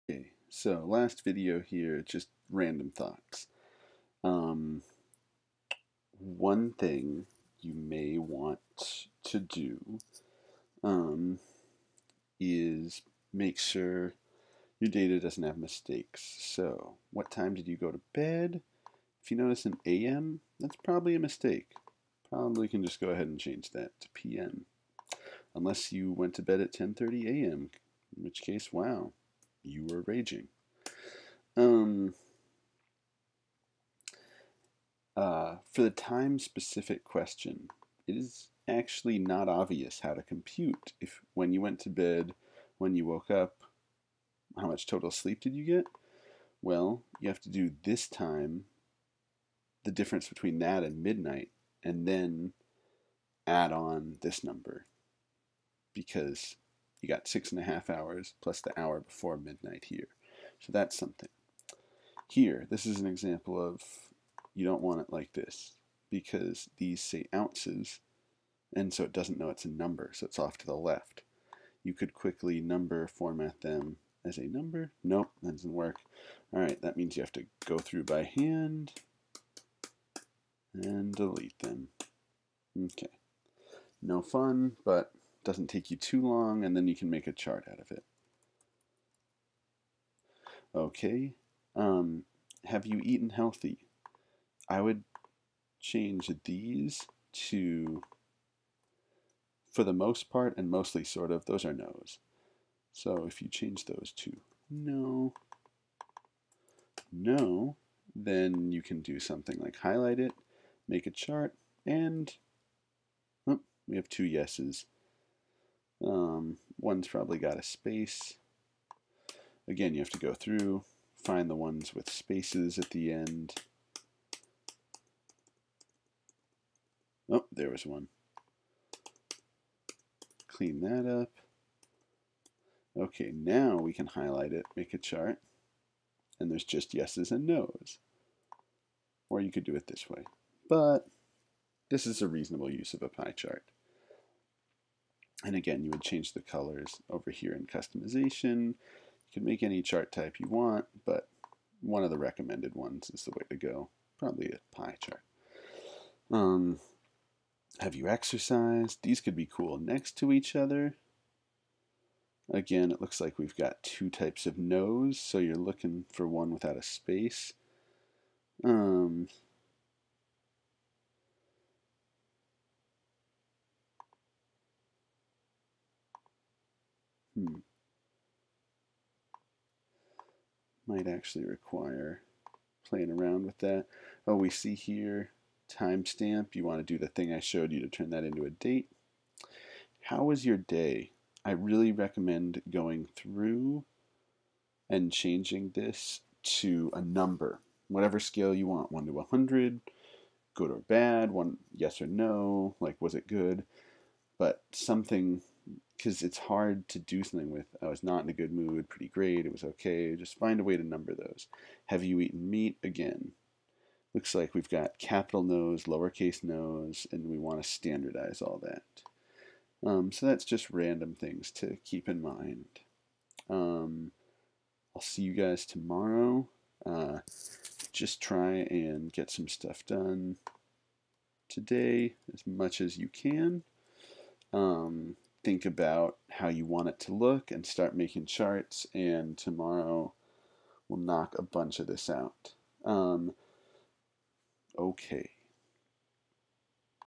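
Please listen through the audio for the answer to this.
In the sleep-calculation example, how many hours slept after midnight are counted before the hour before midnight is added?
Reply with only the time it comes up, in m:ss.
0:57.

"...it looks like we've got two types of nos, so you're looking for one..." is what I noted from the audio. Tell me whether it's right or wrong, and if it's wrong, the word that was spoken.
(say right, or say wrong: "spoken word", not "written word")
right.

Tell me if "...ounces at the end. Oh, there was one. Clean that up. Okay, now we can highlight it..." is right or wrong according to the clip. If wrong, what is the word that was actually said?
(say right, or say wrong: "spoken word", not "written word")
wrong: "spaces", not "ounces".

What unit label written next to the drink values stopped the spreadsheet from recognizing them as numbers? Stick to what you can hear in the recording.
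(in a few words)
ounces.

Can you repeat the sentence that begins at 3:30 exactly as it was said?
Just find a way to number those.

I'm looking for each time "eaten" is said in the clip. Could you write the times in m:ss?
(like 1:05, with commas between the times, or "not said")
1:33, 3:32.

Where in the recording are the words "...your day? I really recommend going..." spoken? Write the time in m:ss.
3:10.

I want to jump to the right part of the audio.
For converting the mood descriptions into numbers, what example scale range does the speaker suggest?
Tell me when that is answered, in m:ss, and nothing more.
3:18.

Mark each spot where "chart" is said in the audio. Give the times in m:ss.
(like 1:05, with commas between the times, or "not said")
1:27, 1:51, 2:14, 2:23, 2:29, 2:35, 3:58.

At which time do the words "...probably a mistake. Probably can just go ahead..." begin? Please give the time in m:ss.
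0:20.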